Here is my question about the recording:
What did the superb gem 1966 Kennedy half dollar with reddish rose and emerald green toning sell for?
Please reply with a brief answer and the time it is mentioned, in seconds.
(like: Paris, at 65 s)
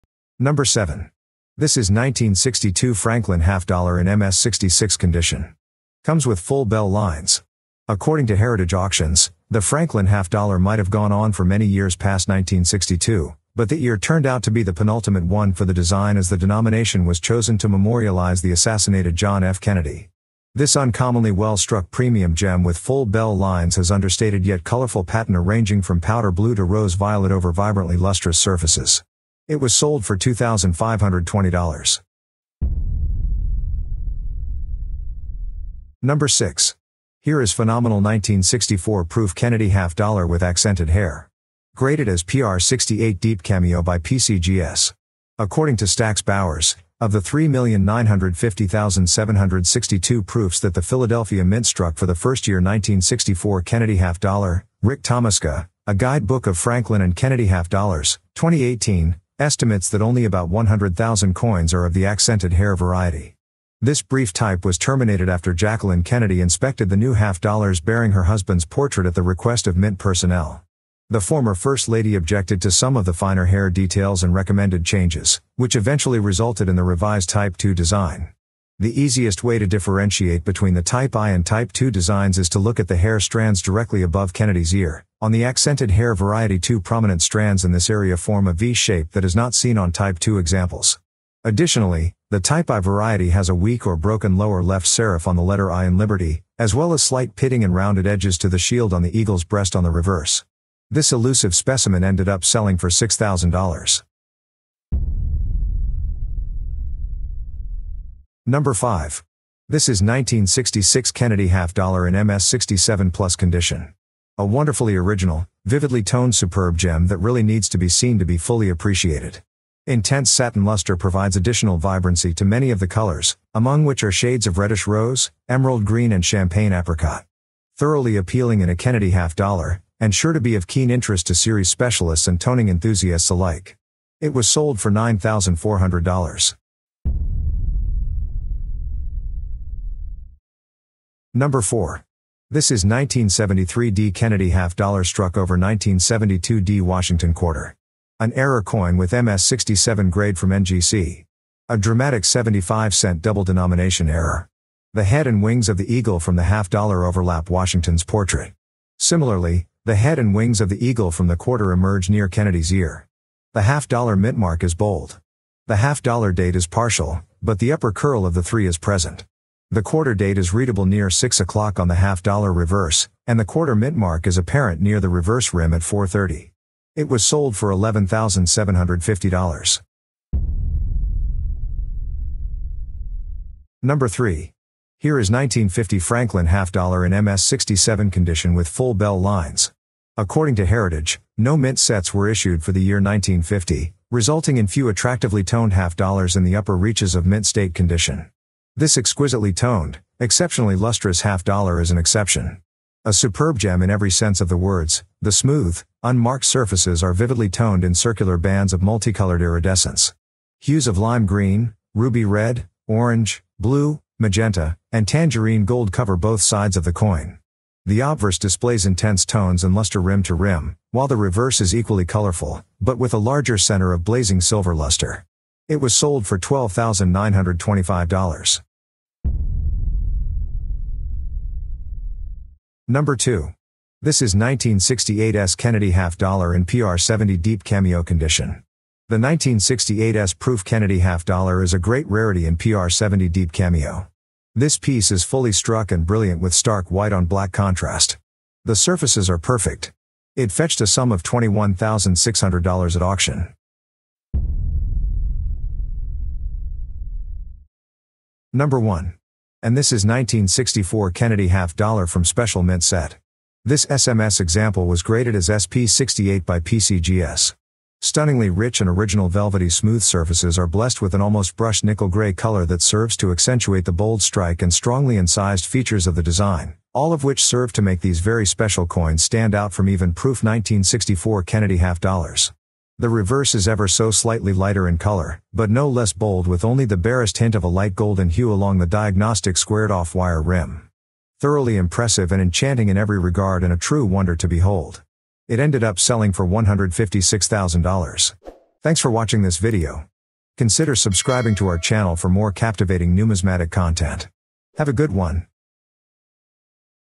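$9,400, at 134 s.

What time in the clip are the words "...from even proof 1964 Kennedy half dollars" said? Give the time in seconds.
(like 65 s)
279 s.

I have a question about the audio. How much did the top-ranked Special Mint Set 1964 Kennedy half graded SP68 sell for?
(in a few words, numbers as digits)
$156,000.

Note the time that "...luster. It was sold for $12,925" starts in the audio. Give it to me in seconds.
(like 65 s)
224 s.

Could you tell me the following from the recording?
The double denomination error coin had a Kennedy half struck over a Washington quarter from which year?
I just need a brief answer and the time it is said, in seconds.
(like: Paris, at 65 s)
1972, at 145 s.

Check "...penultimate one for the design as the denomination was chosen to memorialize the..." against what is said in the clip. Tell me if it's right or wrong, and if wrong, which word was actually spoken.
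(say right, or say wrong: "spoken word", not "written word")
right.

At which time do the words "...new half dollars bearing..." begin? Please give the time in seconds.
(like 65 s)
66 s.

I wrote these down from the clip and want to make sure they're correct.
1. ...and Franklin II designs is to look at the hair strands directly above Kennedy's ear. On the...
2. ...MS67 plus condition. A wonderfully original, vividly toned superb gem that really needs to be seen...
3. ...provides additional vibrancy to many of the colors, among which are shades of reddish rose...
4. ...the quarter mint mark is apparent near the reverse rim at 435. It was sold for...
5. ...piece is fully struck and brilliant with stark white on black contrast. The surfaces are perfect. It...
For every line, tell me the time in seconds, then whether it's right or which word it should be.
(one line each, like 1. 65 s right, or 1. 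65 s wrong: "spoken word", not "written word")
1. 81 s wrong: "Type", not "Franklin"
2. 112 s right
3. 120 s right
4. 173 s wrong: "430", not "435"
5. 244 s right.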